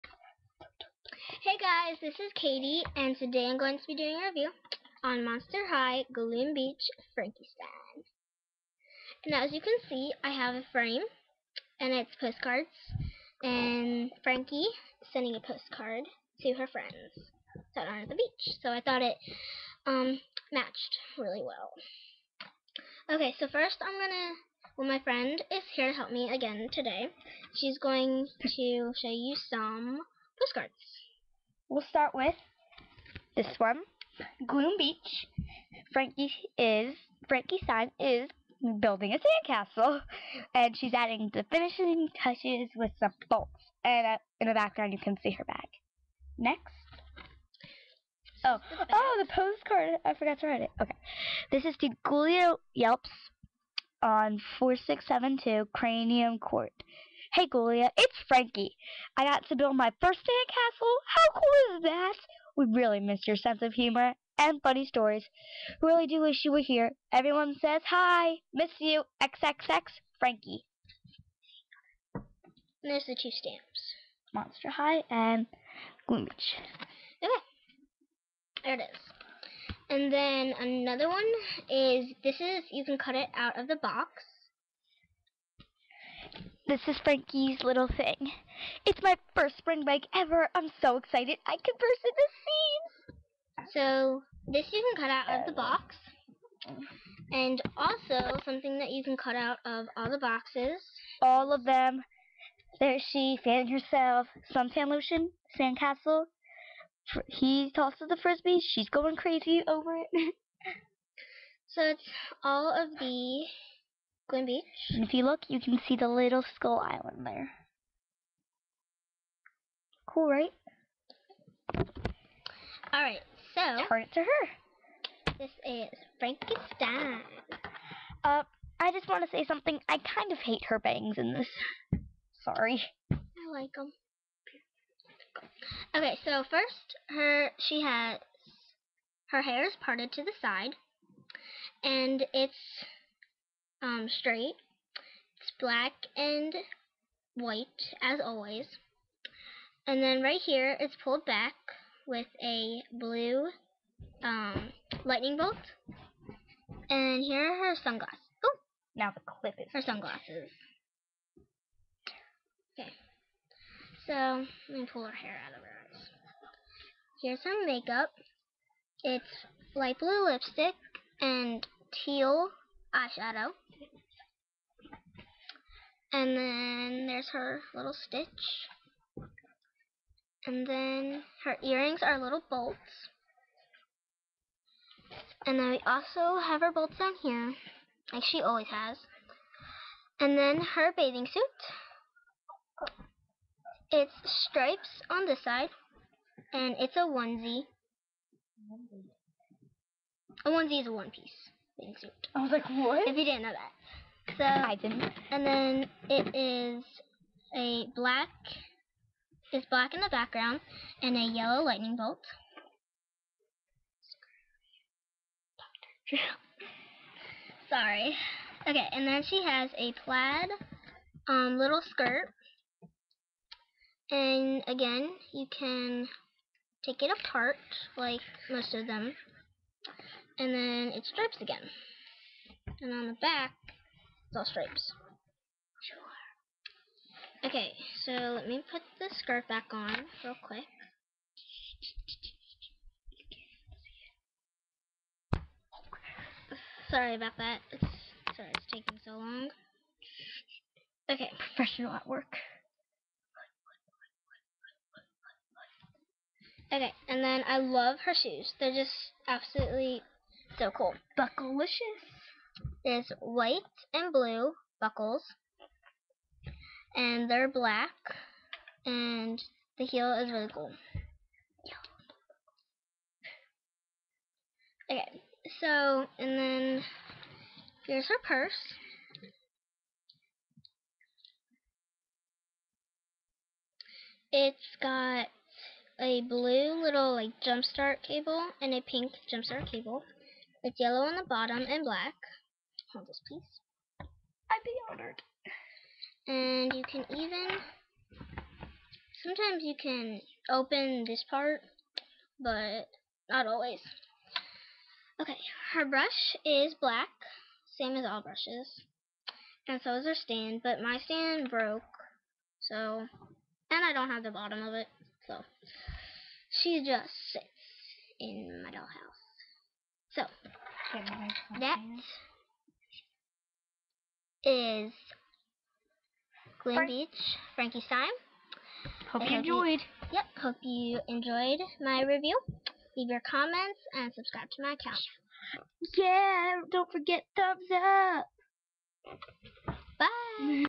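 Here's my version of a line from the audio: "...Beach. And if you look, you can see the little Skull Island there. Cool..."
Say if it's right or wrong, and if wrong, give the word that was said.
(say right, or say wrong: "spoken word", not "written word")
right.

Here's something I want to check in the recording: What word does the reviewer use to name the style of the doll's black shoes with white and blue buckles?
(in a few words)
Buckleicious.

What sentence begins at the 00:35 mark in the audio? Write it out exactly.
Frankie is Frankie Stein is building a sandcastle, and she's adding the finishing touches with some bolts.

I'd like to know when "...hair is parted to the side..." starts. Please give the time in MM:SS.
02:19.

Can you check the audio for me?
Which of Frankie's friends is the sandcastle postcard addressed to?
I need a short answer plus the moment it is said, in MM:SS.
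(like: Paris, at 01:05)
Ghoulia Yelps, at 00:52.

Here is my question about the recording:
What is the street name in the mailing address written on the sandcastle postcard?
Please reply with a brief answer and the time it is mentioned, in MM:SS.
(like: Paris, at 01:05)
Cranium Court, at 00:55.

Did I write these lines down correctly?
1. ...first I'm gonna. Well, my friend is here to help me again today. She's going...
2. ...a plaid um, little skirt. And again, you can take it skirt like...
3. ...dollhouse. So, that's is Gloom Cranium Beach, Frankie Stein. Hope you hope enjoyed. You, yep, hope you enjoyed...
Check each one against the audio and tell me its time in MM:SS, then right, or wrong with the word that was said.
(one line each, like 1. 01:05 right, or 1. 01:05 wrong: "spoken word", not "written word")
1. 00:23 right
2. 03:39 wrong: "apart", not "skirt"
3. 05:18 wrong: "Frank", not "Cranium".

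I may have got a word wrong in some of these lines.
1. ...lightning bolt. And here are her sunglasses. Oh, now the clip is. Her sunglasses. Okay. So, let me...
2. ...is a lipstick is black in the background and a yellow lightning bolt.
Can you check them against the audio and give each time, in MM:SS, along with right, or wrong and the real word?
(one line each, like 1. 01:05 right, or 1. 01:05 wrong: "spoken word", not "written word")
1. 02:35 right
2. 03:26 wrong: "black", not "lipstick".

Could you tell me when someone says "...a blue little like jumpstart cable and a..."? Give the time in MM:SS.
04:45.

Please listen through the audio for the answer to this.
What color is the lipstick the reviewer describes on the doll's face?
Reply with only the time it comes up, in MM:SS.
02:49.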